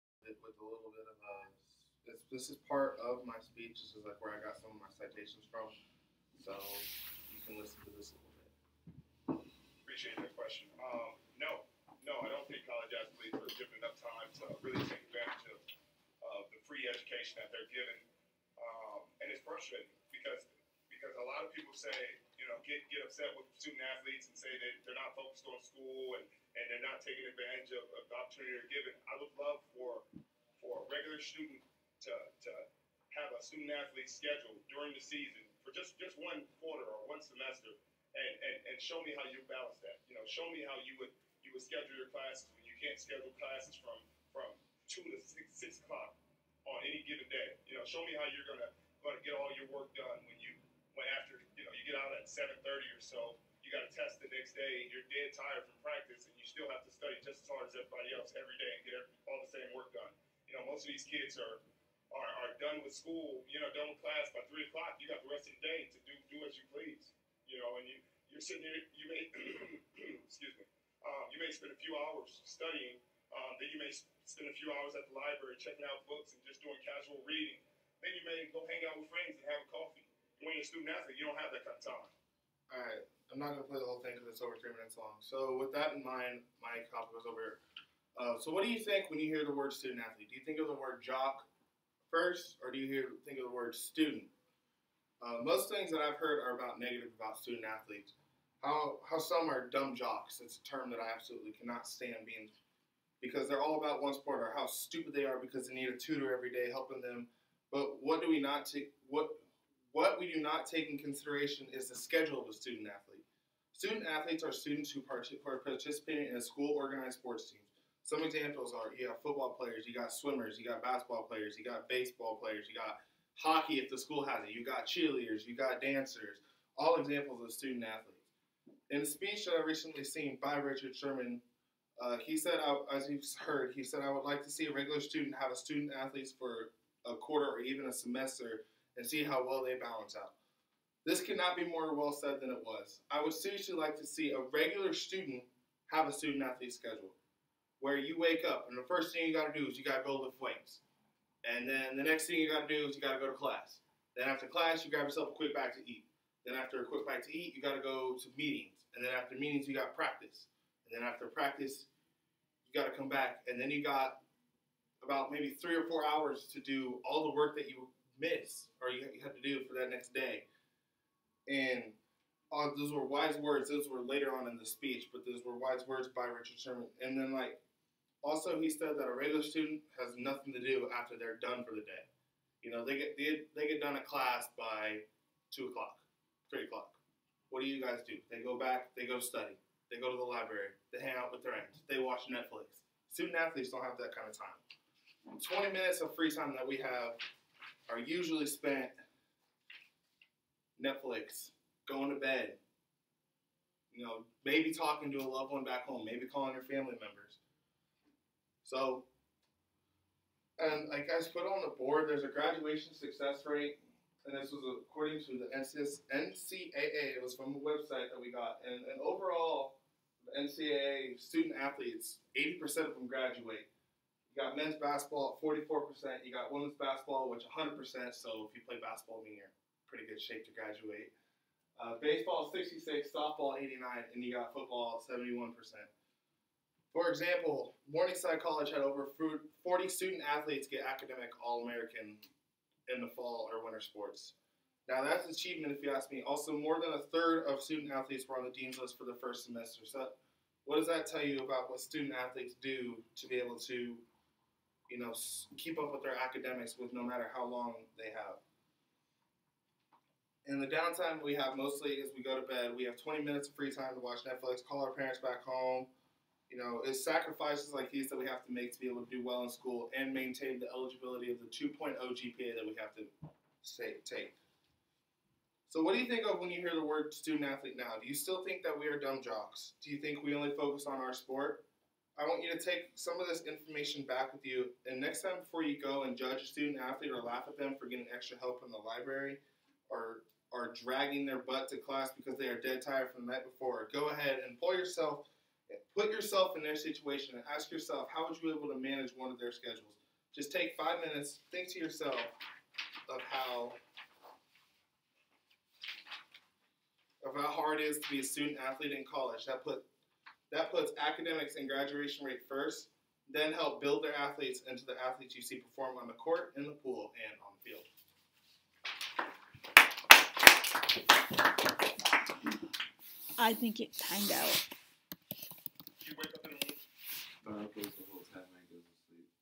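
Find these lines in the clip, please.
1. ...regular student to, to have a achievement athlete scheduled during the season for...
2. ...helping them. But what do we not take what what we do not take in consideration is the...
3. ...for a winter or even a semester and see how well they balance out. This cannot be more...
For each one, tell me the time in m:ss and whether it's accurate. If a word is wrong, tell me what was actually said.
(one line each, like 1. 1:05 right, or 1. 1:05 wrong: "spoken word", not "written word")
1. 0:30 wrong: "student", not "achievement"
2. 1:46 right
3. 2:16 wrong: "quarter", not "winter".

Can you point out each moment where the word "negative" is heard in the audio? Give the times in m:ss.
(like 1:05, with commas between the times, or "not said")
1:36.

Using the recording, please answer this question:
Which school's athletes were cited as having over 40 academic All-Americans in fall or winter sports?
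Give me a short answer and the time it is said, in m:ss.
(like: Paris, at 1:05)
Morningside College, at 3:57.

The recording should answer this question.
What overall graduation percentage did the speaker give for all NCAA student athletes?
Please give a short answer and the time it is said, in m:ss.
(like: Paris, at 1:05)
80%, at 3:42.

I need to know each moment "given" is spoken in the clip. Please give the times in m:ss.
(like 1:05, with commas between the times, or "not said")
0:13, 0:17, 0:28, 0:47.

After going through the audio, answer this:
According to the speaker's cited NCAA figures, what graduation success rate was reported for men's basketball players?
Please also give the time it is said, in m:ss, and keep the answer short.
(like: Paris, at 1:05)
44%, at 3:45.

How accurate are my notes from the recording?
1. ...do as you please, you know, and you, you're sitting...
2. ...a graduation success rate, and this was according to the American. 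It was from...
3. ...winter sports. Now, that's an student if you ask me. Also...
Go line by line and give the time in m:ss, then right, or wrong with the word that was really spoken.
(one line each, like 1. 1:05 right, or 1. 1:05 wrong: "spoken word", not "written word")
1. 1:06 right
2. 3:32 wrong: "NCAA", not "American"
3. 4:03 wrong: "achievement", not "student".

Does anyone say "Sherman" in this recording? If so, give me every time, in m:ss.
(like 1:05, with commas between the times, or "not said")
2:10, 2:56.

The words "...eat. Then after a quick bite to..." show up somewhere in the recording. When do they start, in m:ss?
2:35.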